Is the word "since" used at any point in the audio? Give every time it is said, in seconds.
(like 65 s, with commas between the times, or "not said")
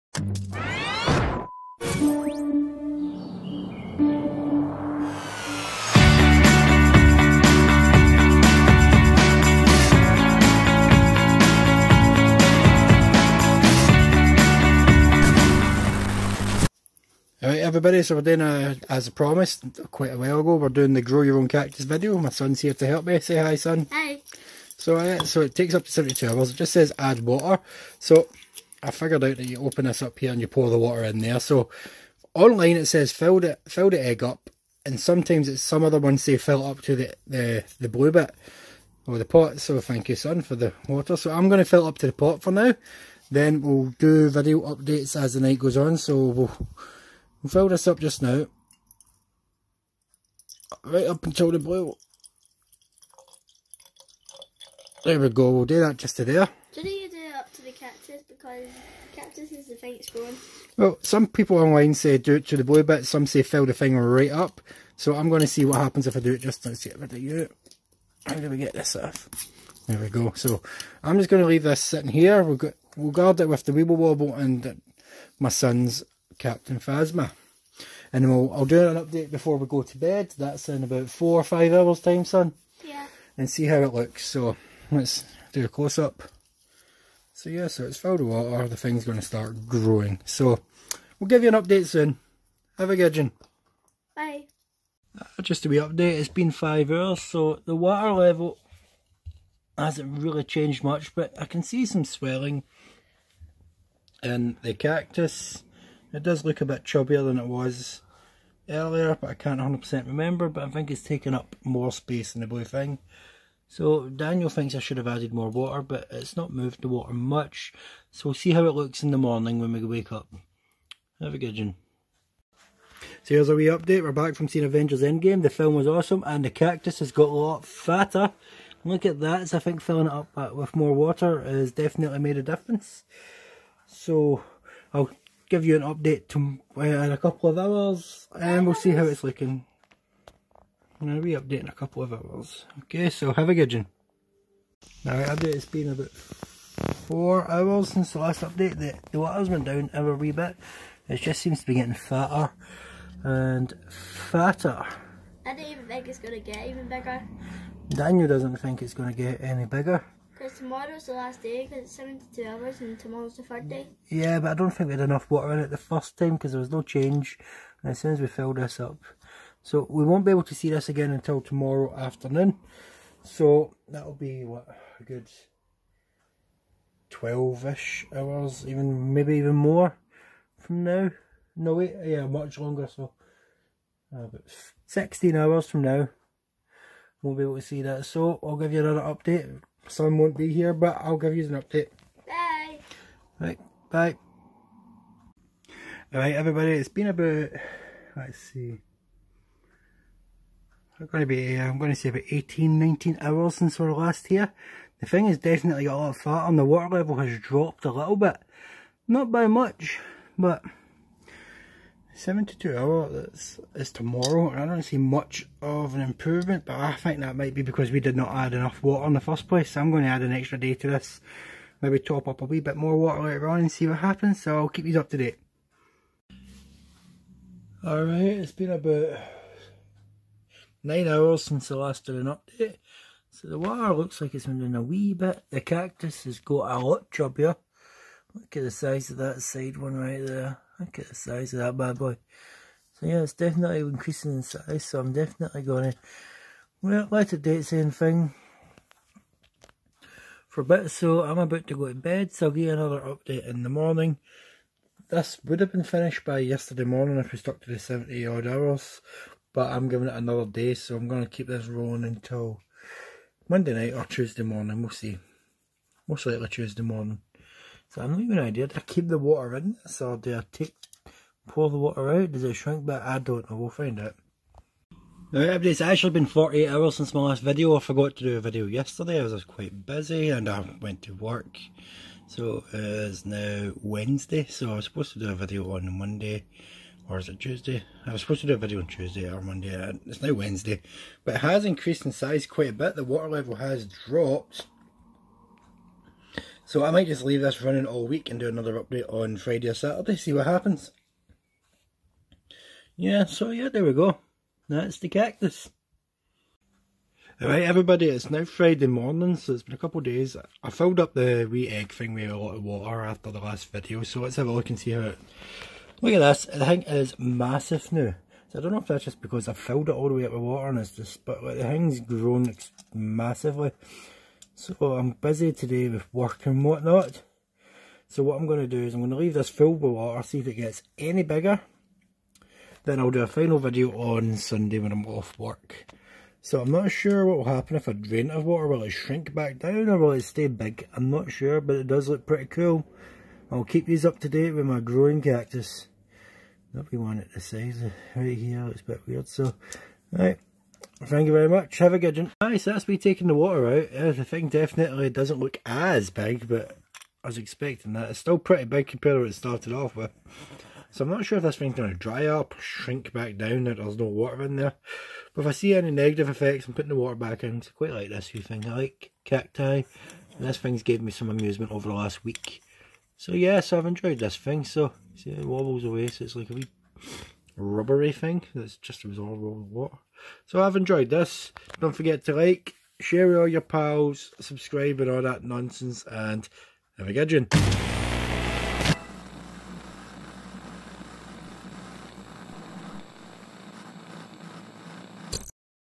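147 s, 203 s, 231 s, 276 s.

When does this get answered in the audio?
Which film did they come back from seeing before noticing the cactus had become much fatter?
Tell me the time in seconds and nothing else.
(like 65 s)
124 s.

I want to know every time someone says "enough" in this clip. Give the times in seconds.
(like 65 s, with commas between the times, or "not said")
165 s, 218 s.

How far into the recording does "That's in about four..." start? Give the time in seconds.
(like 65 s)
80 s.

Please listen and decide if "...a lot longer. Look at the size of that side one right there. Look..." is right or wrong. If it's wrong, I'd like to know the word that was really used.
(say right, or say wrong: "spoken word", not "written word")
wrong: "chubbier", not "longer".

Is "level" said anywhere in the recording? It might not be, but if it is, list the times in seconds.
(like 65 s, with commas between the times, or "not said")
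98 s, 206 s, 293 s.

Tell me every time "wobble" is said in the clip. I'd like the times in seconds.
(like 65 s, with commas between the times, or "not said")
73 s, 375 s.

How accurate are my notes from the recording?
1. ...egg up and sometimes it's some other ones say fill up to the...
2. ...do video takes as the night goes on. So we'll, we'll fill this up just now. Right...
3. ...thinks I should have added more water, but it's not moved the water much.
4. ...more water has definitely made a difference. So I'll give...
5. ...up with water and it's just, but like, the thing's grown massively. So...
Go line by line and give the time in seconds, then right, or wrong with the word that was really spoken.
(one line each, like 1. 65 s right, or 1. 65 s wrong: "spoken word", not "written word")
1. 34 s right
2. 43 s wrong: "updates", not "takes"
3. 114 s right
4. 130 s right
5. 320 s right.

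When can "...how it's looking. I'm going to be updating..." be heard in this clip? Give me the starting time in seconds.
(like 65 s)
138 s.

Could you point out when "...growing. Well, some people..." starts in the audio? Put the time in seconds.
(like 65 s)
60 s.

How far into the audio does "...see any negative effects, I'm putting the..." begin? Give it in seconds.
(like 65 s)
365 s.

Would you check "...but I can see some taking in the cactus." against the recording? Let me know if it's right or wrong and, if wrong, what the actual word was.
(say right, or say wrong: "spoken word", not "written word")
wrong: "swelling", not "taking".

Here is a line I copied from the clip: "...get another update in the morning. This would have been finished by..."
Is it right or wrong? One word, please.
right.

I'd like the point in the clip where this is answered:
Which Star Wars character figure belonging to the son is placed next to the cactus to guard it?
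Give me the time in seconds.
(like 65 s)
76 s.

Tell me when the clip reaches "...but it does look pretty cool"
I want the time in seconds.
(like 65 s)
341 s.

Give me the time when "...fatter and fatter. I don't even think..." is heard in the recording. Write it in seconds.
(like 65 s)
151 s.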